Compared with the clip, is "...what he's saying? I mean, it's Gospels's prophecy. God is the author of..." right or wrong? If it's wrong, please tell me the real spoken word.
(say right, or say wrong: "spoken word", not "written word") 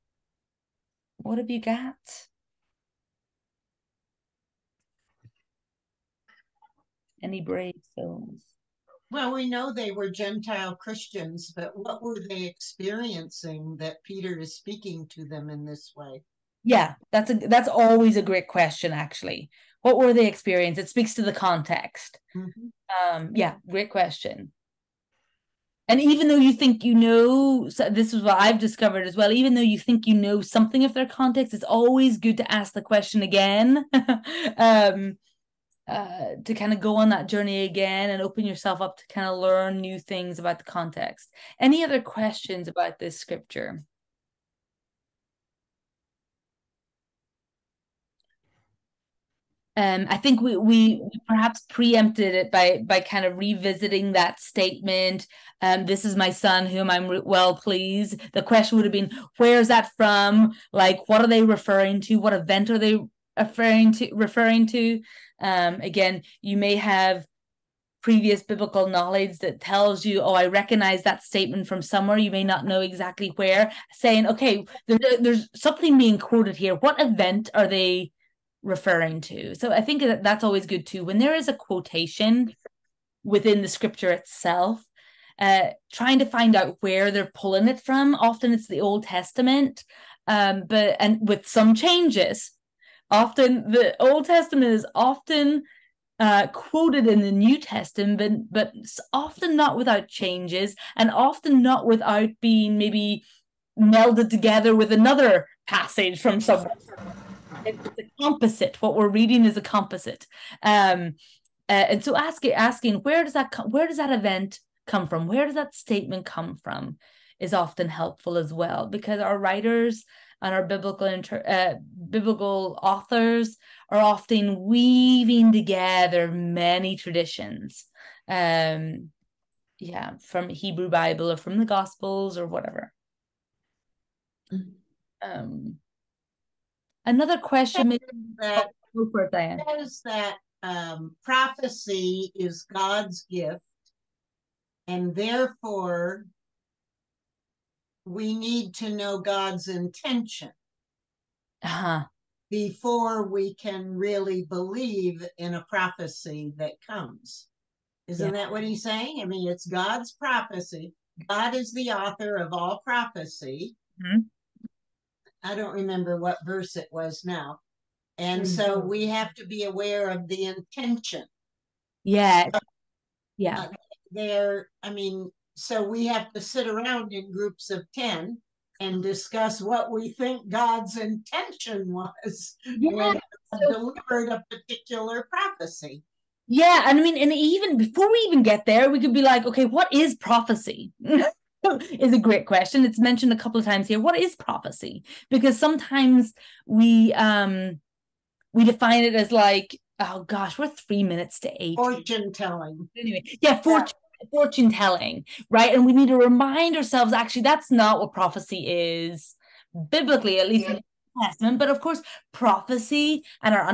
wrong: "God", not "Gospels".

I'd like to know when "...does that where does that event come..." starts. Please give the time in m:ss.
1:53.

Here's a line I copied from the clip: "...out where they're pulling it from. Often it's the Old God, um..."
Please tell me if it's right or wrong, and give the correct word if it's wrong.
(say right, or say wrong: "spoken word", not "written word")
wrong: "Testament", not "God".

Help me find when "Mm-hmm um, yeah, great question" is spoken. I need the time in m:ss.
0:22.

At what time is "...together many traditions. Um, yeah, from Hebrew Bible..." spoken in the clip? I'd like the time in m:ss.
2:05.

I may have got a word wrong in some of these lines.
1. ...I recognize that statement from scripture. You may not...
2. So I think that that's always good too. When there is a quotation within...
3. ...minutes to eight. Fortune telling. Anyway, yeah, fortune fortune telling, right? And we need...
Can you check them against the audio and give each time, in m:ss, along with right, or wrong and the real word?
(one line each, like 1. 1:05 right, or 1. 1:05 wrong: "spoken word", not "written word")
1. 1:10 wrong: "somewhere", not "scripture"
2. 1:19 right
3. 3:21 right.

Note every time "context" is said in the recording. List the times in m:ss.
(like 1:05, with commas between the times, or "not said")
0:21, 0:31, 0:40.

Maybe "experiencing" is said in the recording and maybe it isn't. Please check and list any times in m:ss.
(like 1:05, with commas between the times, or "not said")
0:12, 0:20.